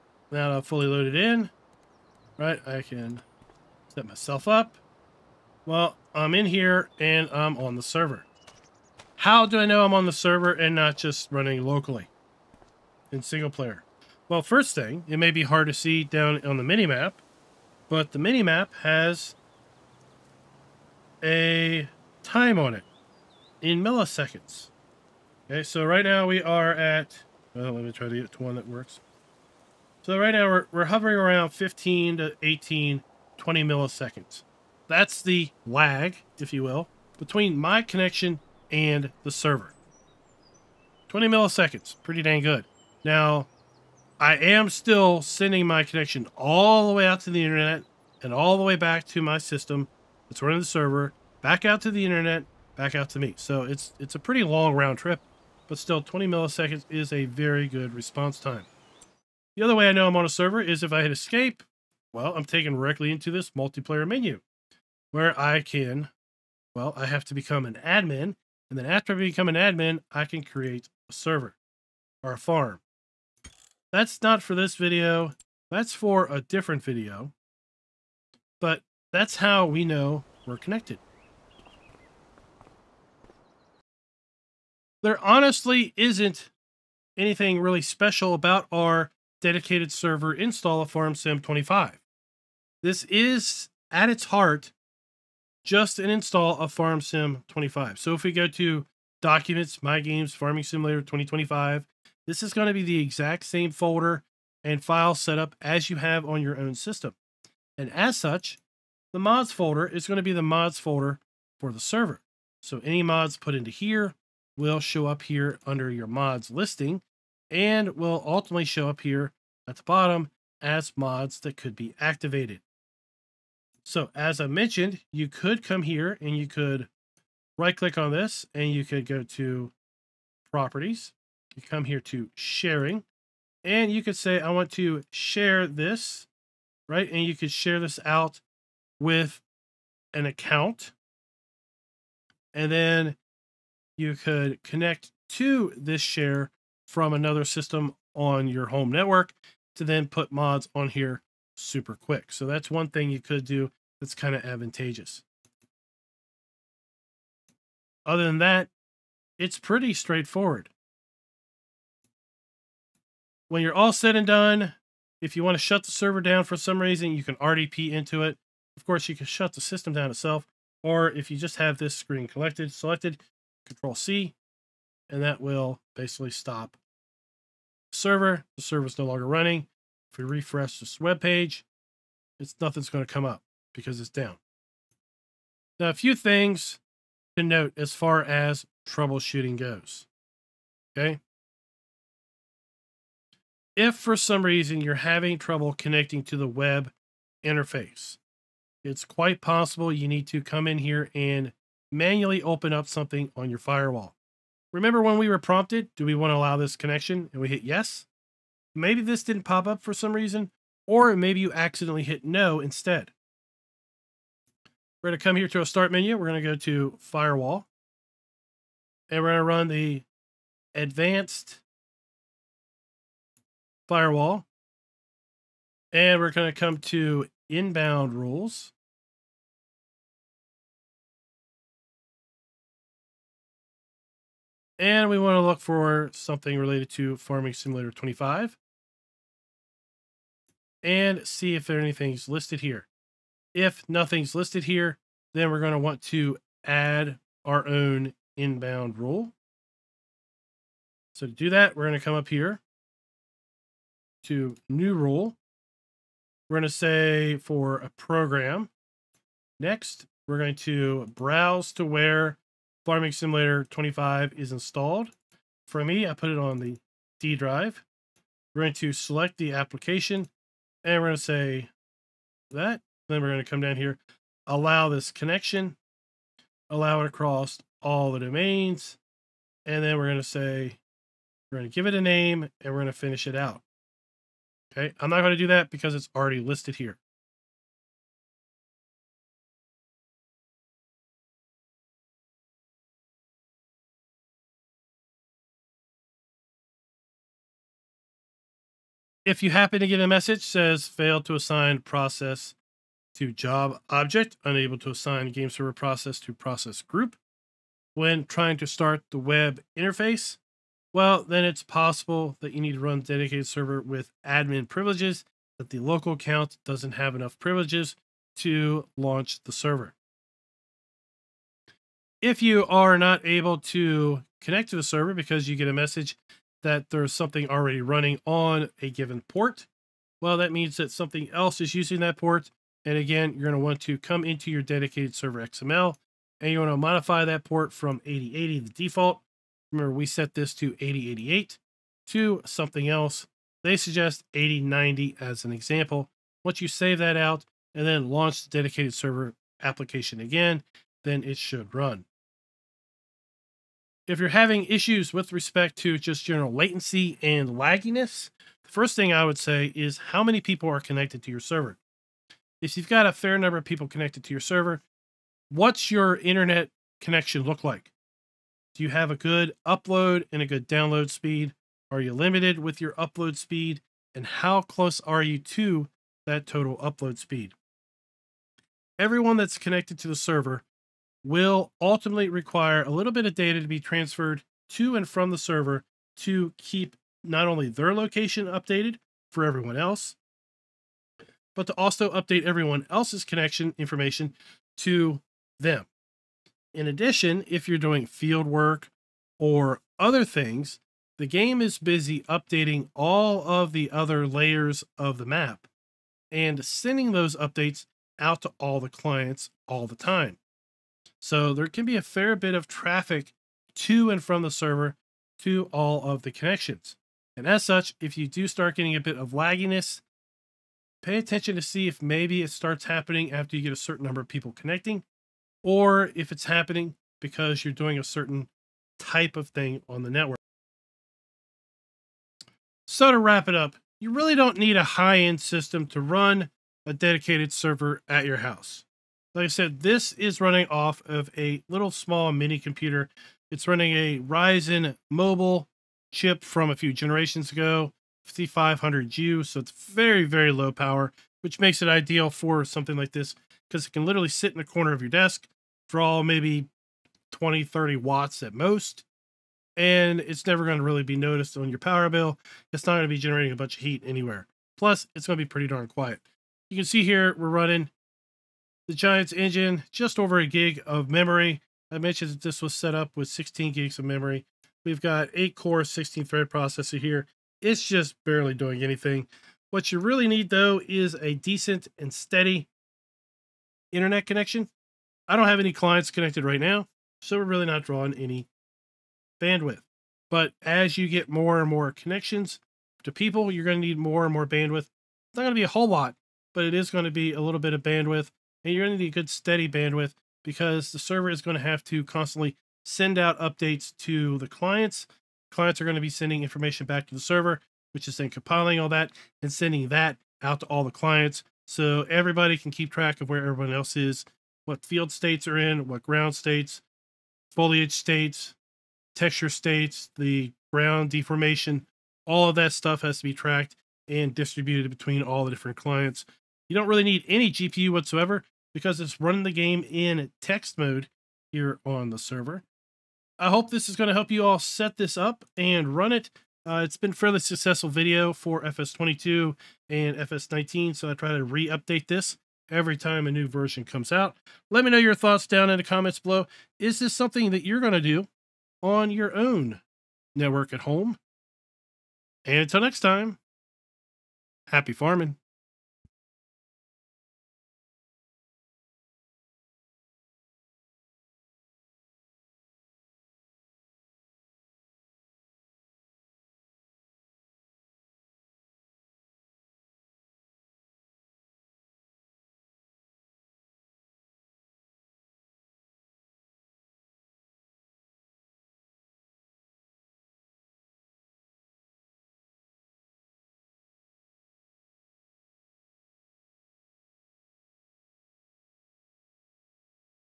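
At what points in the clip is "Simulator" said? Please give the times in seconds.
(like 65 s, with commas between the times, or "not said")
100 s, 237 s, 263 s.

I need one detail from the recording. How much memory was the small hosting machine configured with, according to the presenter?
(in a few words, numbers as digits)
16 gigs.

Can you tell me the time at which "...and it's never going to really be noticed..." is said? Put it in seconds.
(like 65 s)
459 s.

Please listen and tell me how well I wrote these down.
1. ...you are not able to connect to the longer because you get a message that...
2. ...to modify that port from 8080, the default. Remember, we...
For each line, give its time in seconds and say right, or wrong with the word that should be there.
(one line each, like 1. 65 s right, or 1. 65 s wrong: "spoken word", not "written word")
1. 322 s wrong: "server", not "longer"
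2. 336 s right.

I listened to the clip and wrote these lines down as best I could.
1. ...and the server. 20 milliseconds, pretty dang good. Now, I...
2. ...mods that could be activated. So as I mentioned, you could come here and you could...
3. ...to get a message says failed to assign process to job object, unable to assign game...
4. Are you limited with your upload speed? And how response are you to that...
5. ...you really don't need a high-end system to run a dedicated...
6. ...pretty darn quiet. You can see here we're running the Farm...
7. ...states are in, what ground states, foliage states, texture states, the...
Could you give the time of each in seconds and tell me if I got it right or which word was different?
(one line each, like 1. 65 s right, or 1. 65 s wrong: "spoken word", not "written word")
1. 38 s right
2. 120 s right
3. 299 s right
4. 371 s wrong: "close", not "response"
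5. 433 s right
6. 465 s wrong: "Giants", not "Farm"
7. 515 s right.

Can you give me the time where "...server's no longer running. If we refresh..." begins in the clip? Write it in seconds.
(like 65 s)
178 s.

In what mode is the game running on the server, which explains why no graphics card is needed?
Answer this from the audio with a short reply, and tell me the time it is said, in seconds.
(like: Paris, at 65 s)
text mode, at 530 s.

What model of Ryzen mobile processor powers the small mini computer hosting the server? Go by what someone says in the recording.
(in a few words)
5500U.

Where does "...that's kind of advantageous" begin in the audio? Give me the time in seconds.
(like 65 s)
153 s.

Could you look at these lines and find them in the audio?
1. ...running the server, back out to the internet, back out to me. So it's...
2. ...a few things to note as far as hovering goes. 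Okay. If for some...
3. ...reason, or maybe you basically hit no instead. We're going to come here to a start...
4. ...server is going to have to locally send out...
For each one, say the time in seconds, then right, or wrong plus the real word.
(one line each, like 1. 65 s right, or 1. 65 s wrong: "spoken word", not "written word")
1. 50 s right
2. 185 s wrong: "troubleshooting", not "hovering"
3. 210 s wrong: "accidentally", not "basically"
4. 500 s wrong: "constantly", not "locally".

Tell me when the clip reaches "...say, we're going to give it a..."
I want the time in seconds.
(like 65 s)
280 s.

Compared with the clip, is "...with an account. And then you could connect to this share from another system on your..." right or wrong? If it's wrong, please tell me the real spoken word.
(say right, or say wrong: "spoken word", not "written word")
right.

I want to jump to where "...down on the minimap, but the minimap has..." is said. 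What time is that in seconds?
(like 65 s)
16 s.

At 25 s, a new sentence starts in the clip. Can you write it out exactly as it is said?
Okay, so right now we are at, well, let me try to get to one that works.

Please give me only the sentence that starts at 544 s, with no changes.
Let me know your thoughts down in the comments below.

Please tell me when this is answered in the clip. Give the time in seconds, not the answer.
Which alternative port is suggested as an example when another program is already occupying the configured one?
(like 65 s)
344 s.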